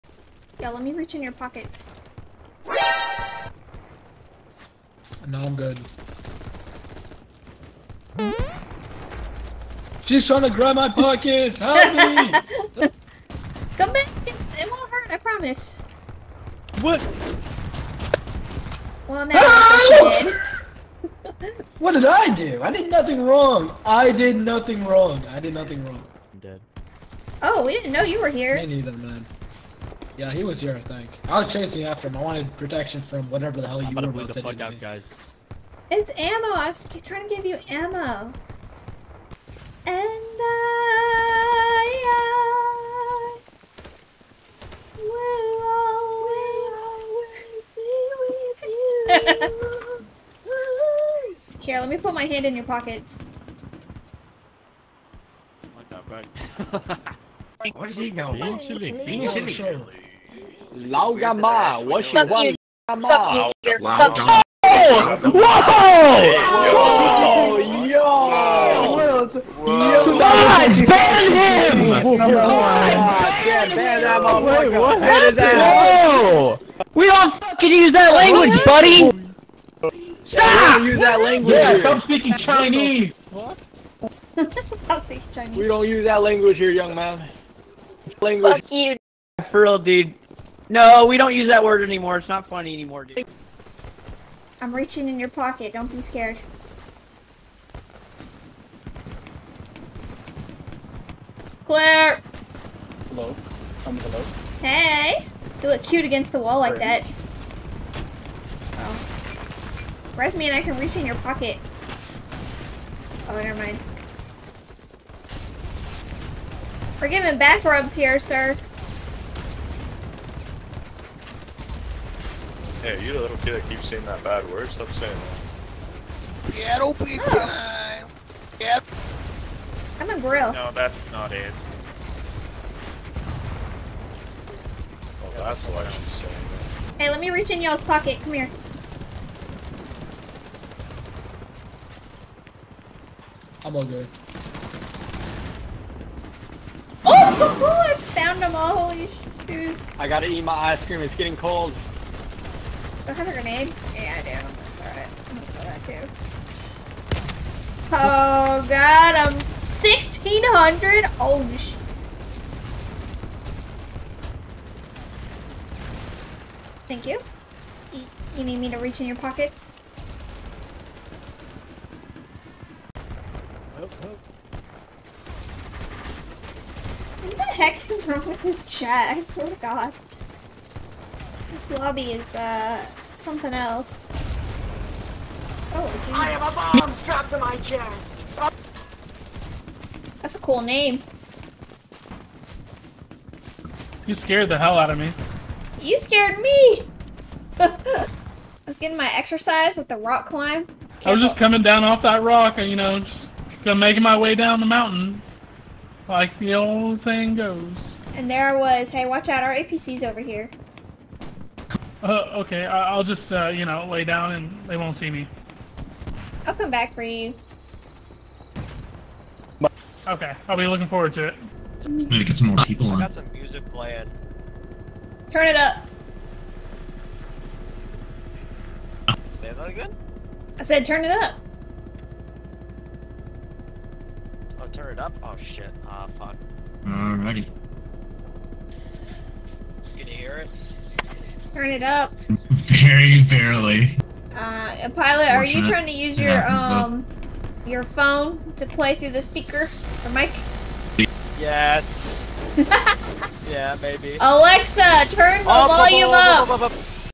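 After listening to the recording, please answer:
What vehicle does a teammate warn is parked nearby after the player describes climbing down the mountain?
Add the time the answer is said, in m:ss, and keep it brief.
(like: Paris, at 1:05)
APC, at 3:29.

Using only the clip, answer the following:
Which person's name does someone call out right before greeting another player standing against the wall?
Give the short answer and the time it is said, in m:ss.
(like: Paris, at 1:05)
Claire, at 1:41.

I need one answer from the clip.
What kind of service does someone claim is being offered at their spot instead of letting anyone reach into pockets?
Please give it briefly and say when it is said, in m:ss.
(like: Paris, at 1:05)
Back rubs, at 1:57.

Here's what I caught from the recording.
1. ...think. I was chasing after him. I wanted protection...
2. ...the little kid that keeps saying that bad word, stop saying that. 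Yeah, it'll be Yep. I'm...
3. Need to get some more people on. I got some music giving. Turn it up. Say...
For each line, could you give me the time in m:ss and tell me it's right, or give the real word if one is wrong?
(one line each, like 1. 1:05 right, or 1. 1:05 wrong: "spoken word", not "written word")
1. 0:30 right
2. 2:03 right
3. 3:41 wrong: "playing", not "giving".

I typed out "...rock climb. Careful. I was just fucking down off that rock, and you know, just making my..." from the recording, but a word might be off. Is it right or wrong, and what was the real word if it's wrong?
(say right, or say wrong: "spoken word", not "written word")
wrong: "coming", not "fucking".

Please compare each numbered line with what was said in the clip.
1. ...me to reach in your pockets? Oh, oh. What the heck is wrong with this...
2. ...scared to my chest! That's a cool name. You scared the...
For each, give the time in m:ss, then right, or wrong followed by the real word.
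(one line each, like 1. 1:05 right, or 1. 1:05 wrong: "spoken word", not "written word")
1. 2:48 right
2. 3:07 wrong: "strapped", not "scared".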